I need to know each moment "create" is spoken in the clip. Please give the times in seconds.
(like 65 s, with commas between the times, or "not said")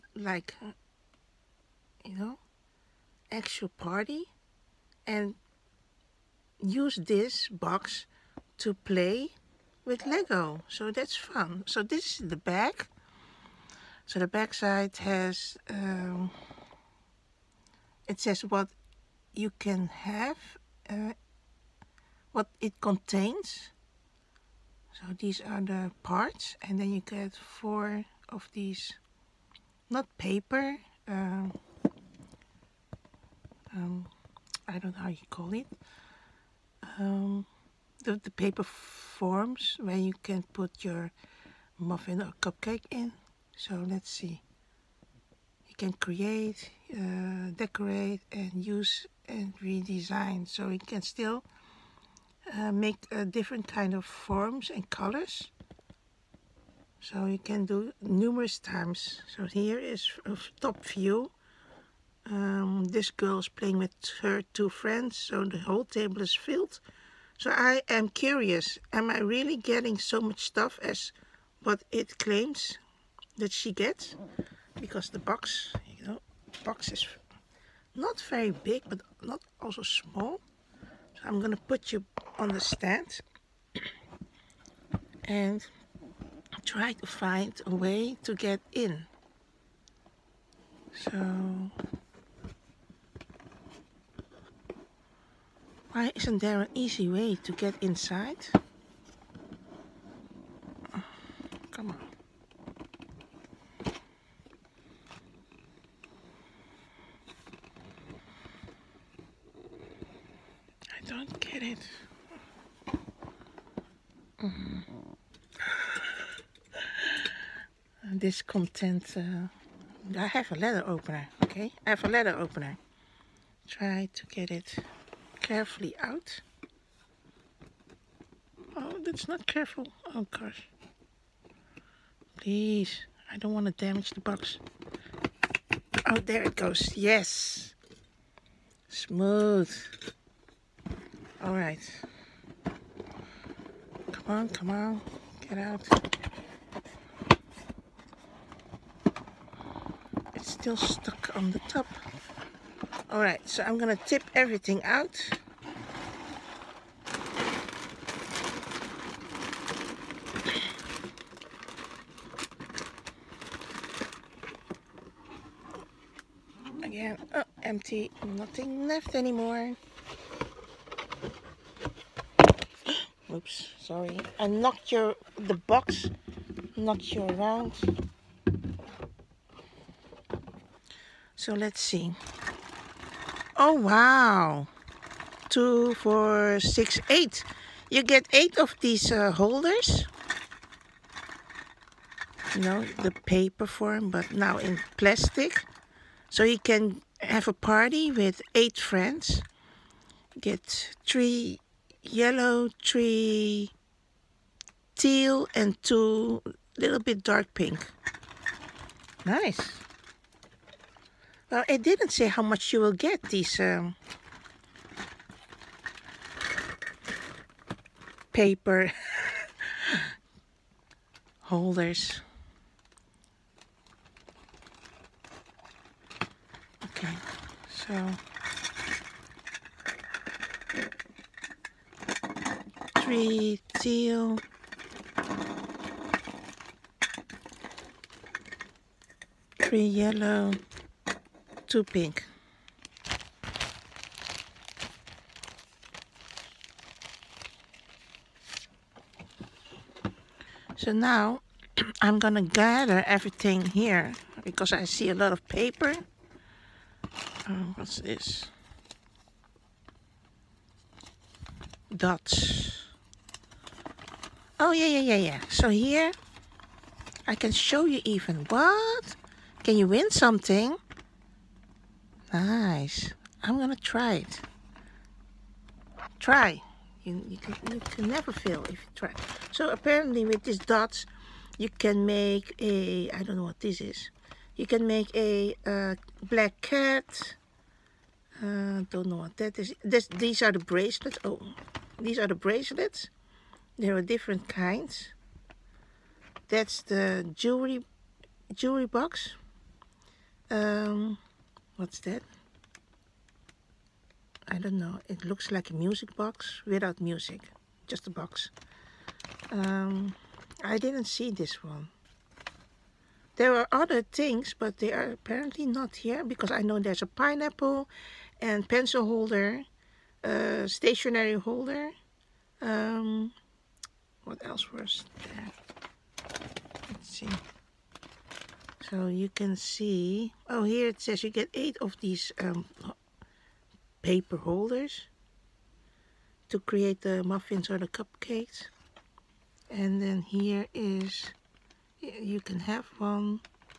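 45 s, 336 s.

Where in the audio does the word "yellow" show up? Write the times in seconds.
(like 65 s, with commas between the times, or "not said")
202 s, 239 s.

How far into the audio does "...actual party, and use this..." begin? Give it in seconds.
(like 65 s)
3 s.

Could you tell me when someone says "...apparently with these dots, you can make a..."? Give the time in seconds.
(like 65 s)
279 s.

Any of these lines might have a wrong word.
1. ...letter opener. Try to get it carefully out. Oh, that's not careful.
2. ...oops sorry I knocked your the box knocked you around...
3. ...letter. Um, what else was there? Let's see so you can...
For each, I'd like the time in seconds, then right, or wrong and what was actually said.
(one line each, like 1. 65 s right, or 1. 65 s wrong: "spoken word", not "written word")
1. 122 s right
2. 173 s right
3. 321 s wrong: "holder", not "letter".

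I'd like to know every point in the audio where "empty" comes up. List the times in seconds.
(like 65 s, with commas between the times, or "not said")
167 s.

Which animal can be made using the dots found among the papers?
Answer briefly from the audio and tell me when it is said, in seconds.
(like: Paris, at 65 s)
Black cat, at 286 s.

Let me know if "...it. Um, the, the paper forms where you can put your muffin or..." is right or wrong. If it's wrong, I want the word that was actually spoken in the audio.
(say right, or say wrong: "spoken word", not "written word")
right.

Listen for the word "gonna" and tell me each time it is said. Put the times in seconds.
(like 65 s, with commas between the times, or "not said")
81 s, 153 s, 273 s.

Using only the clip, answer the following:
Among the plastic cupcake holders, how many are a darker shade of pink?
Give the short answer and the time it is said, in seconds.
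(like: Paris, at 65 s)
2, at 205 s.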